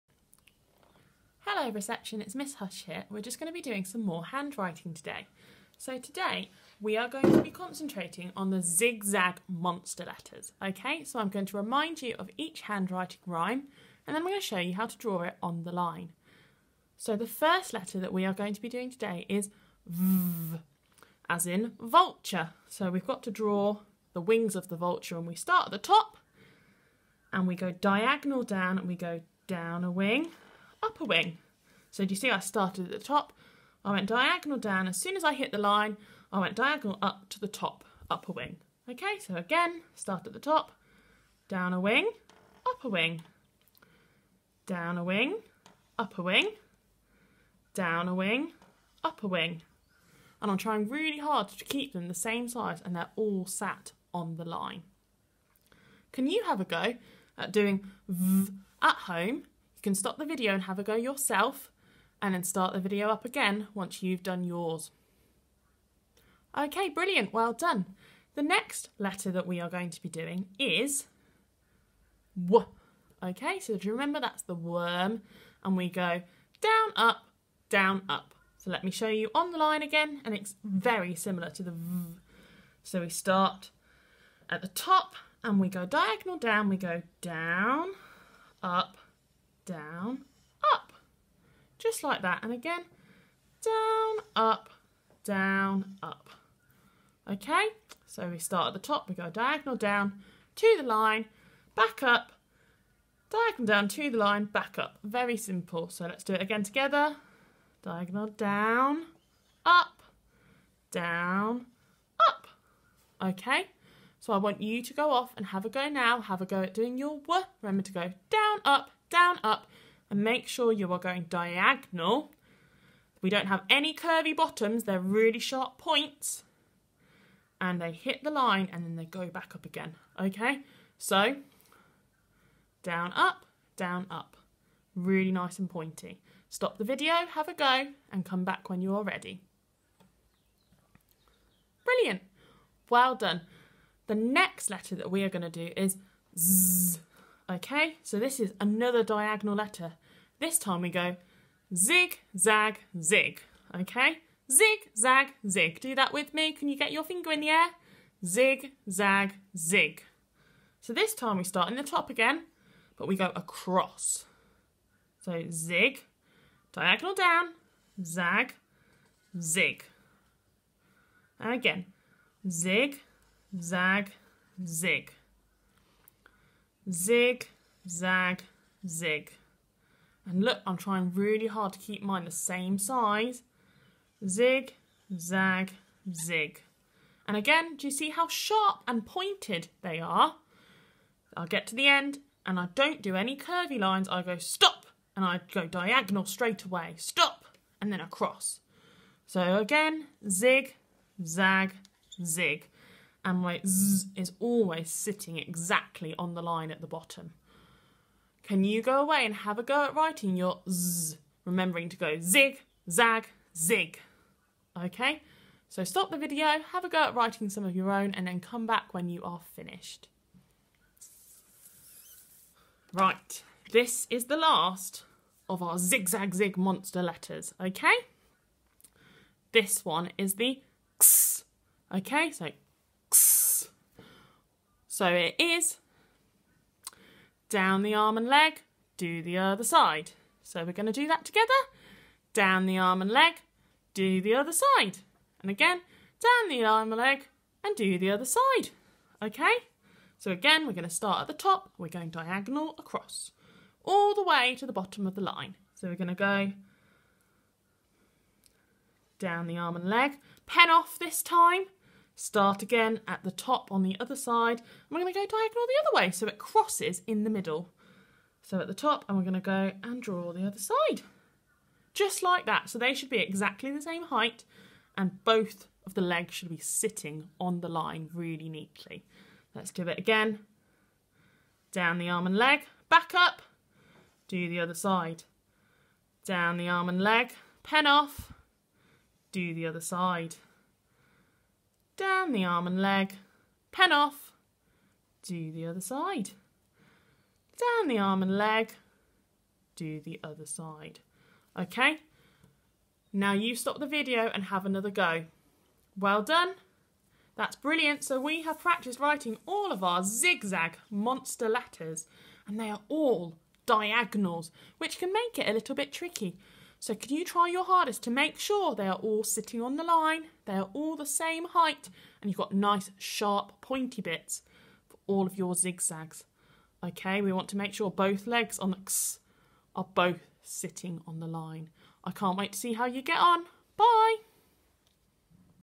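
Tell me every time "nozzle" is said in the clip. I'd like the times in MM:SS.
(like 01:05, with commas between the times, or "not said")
not said.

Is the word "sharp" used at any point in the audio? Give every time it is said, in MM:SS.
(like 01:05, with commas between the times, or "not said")
02:05, 03:08, 05:22.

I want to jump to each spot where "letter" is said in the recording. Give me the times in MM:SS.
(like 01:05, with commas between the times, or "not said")
00:10, 00:17, 01:08, 02:24, 02:29, 03:47, 05:11.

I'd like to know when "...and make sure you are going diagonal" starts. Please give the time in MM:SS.
02:00.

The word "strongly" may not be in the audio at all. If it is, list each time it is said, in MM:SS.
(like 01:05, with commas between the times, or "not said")
not said.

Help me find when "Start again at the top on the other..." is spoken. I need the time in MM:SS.
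04:22.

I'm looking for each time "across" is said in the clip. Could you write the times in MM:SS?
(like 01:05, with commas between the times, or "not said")
02:43, 03:18, 04:12.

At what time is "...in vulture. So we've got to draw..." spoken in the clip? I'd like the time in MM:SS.
00:21.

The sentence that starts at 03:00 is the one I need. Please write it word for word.
And look, I'm trying really hard to keep mine the same size.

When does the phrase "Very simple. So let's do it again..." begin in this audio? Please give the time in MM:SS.
01:45.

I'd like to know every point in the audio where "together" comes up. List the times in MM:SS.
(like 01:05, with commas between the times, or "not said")
01:46, 04:01.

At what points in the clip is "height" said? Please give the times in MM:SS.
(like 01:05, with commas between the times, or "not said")
04:34, 05:21.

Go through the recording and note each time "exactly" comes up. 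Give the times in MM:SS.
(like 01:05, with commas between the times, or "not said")
03:25, 04:33.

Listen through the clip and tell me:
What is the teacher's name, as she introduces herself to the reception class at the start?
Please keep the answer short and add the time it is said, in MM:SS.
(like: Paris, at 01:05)
Miss Huish, at 00:02.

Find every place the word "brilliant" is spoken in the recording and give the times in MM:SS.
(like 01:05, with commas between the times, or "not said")
01:06, 02:21, 05:07.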